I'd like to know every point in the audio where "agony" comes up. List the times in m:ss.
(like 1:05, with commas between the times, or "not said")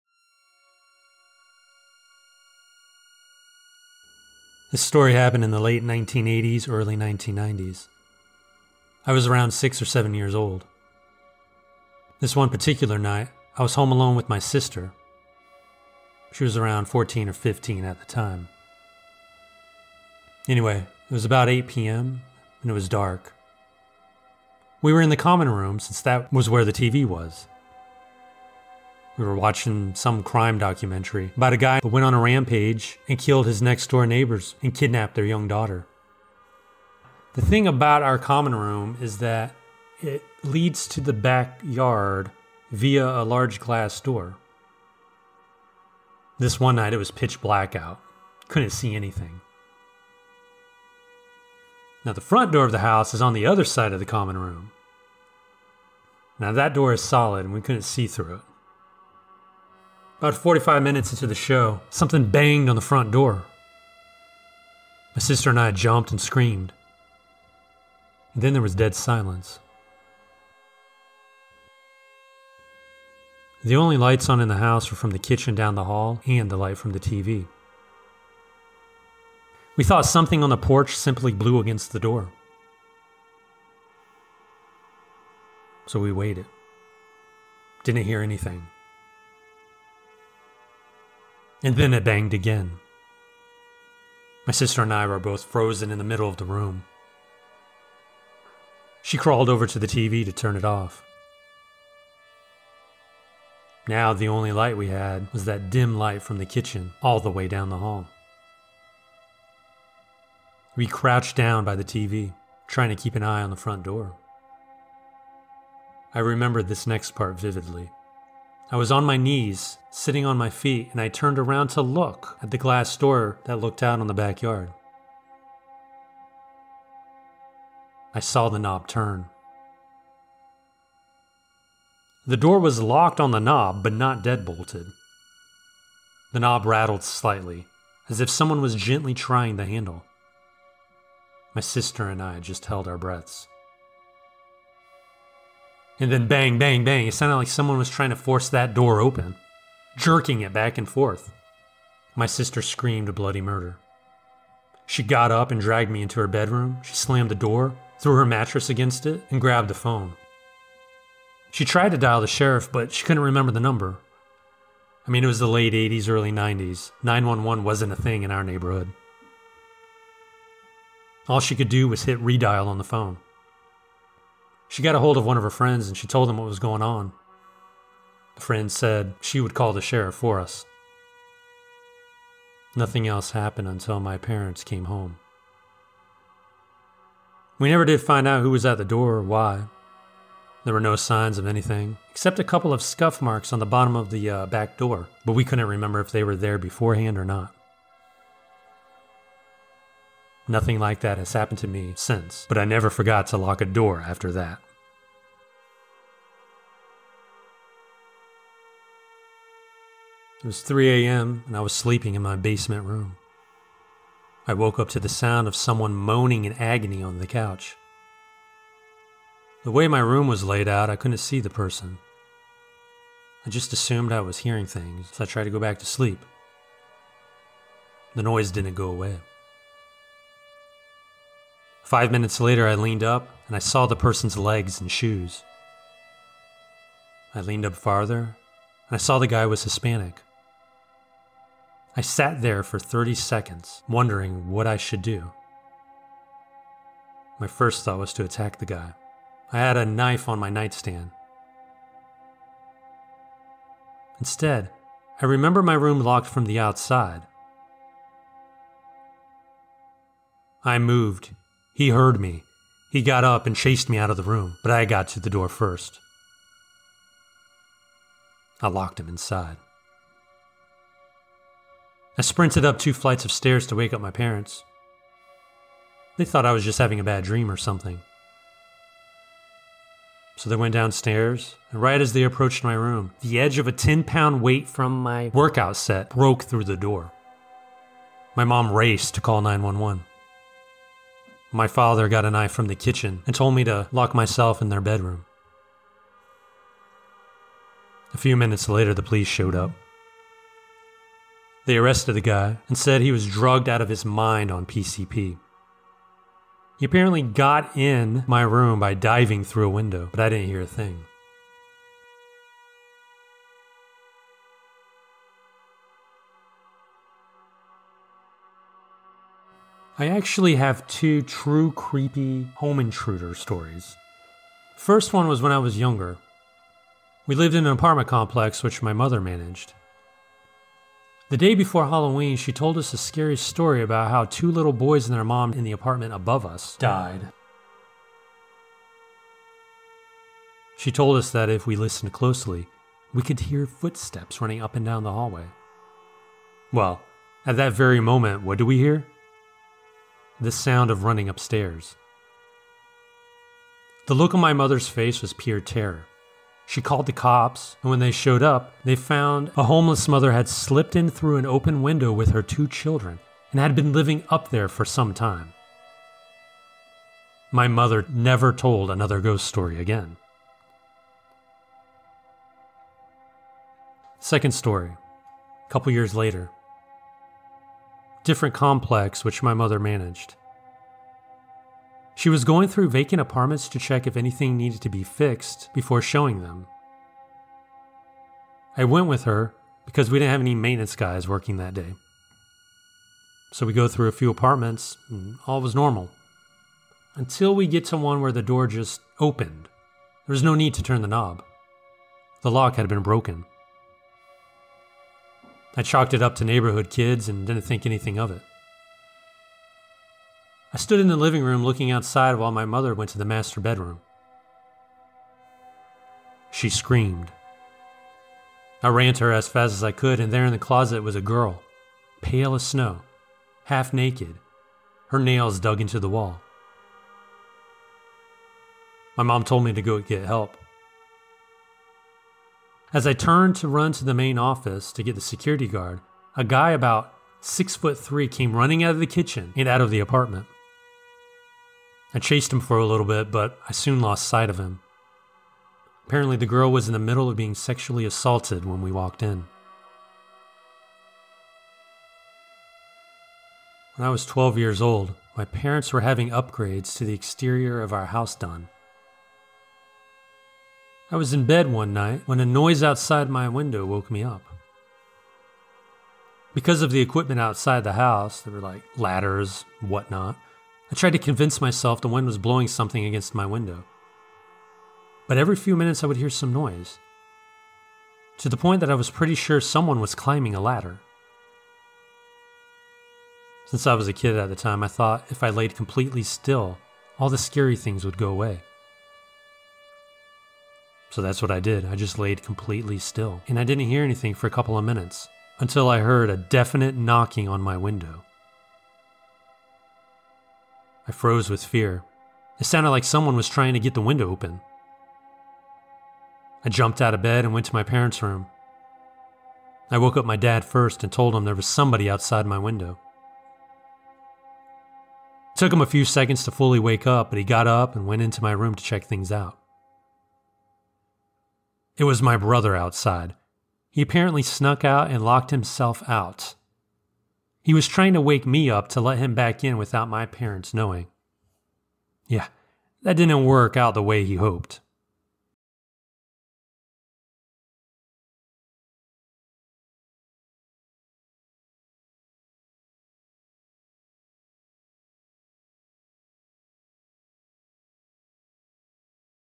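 3:36.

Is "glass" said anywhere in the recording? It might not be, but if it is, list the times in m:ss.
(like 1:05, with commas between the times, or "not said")
0:43, 2:02.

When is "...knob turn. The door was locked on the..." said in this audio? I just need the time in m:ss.
2:08.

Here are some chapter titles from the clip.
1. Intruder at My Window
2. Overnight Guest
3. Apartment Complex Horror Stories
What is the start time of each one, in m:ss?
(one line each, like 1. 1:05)
1. 7:33
2. 3:27
3. 5:15.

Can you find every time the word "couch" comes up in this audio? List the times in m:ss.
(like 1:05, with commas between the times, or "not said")
3:37.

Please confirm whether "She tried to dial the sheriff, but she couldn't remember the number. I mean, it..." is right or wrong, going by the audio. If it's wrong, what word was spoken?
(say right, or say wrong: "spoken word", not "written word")
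right.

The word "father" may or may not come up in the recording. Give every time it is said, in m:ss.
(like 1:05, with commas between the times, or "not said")
4:51.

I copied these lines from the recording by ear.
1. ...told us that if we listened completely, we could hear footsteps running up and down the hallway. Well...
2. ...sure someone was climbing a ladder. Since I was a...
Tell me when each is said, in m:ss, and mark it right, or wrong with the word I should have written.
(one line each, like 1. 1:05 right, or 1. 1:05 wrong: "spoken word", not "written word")
1. 5:40 wrong: "closely", not "completely"
2. 7:59 right.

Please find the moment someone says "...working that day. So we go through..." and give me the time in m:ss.
6:31.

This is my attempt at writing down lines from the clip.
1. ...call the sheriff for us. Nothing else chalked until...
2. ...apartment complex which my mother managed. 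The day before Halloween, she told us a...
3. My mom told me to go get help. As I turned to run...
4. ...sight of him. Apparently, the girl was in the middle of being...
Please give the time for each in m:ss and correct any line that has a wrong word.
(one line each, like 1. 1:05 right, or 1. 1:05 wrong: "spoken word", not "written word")
1. 2:59 wrong: "happened", not "chalked"
2. 5:27 right
3. 7:09 right
4. 7:24 right.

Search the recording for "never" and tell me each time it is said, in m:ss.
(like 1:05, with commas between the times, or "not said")
3:07, 3:22, 6:08.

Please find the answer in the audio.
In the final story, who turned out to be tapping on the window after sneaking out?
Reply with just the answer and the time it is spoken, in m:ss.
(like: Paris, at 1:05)
my brother, at 8:42.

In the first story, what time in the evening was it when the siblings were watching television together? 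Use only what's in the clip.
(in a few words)
8 p.m.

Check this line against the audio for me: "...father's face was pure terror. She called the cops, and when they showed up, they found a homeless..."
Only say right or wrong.
wrong.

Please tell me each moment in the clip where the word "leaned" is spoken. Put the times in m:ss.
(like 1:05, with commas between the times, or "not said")
3:52, 3:57.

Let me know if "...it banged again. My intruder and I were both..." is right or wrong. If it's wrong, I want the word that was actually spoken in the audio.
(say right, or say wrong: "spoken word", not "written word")
wrong: "sister", not "intruder".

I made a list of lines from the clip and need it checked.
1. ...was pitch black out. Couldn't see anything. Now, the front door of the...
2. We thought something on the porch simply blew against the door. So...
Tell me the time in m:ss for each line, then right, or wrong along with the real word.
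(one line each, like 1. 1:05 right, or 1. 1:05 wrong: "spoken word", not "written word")
1. 0:46 right
2. 1:19 right.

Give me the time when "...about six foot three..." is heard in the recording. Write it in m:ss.
7:16.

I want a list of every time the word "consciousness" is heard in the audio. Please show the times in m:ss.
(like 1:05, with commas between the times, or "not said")
not said.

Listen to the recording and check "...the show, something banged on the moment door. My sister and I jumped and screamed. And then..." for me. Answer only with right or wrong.
wrong.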